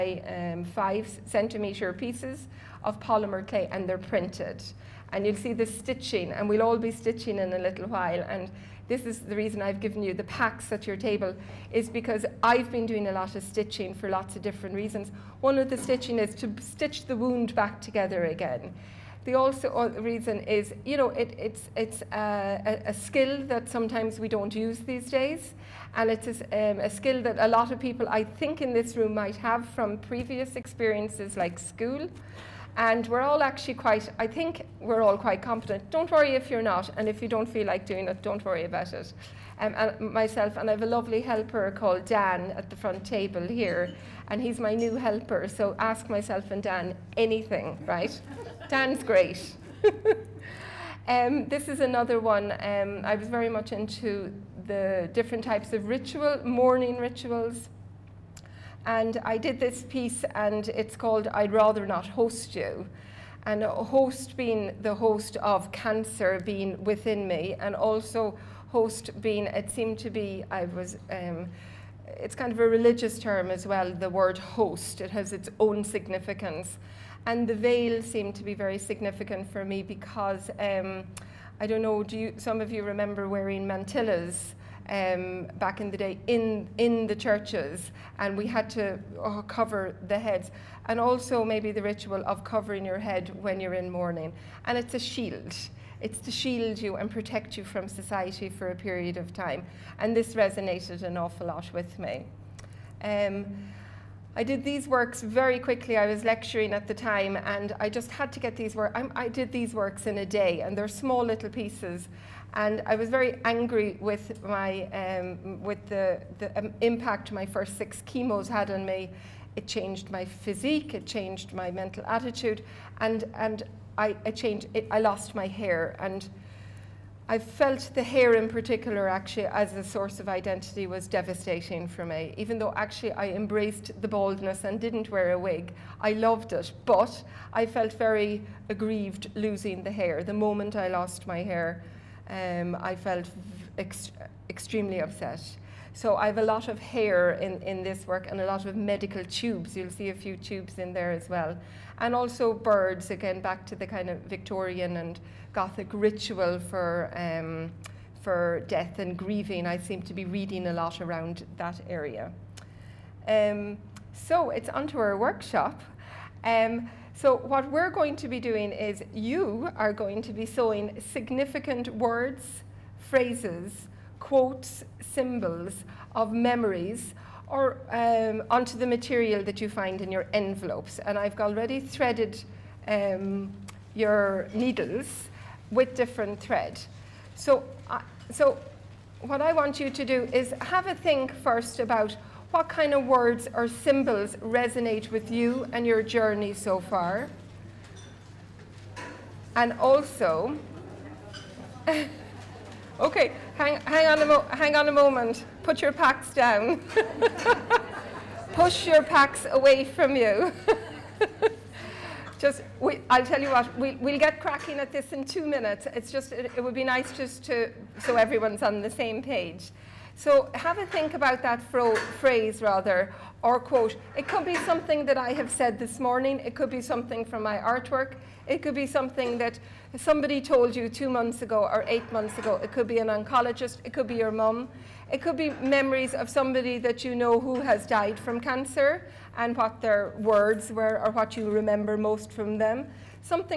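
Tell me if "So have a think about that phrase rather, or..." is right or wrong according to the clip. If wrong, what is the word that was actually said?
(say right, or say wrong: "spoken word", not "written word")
right.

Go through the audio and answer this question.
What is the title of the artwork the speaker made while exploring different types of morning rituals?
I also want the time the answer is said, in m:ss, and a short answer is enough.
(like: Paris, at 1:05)
I'd Rather Not Host You, at 1:01.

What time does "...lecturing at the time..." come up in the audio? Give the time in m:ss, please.
1:46.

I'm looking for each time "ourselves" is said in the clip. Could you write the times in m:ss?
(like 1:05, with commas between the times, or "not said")
not said.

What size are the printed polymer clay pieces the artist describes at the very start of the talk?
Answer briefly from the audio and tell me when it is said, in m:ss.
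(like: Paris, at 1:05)
5 centimeters, at 0:00.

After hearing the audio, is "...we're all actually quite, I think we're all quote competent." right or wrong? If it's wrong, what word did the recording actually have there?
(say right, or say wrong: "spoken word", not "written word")
wrong: "quite", not "quote".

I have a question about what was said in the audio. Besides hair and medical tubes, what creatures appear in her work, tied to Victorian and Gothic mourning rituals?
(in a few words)
Birds.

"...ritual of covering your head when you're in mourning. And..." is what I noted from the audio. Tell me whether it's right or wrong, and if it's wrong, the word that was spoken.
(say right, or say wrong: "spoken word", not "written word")
right.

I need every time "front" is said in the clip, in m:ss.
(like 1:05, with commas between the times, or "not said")
0:42.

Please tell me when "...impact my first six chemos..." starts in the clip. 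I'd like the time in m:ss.
1:56.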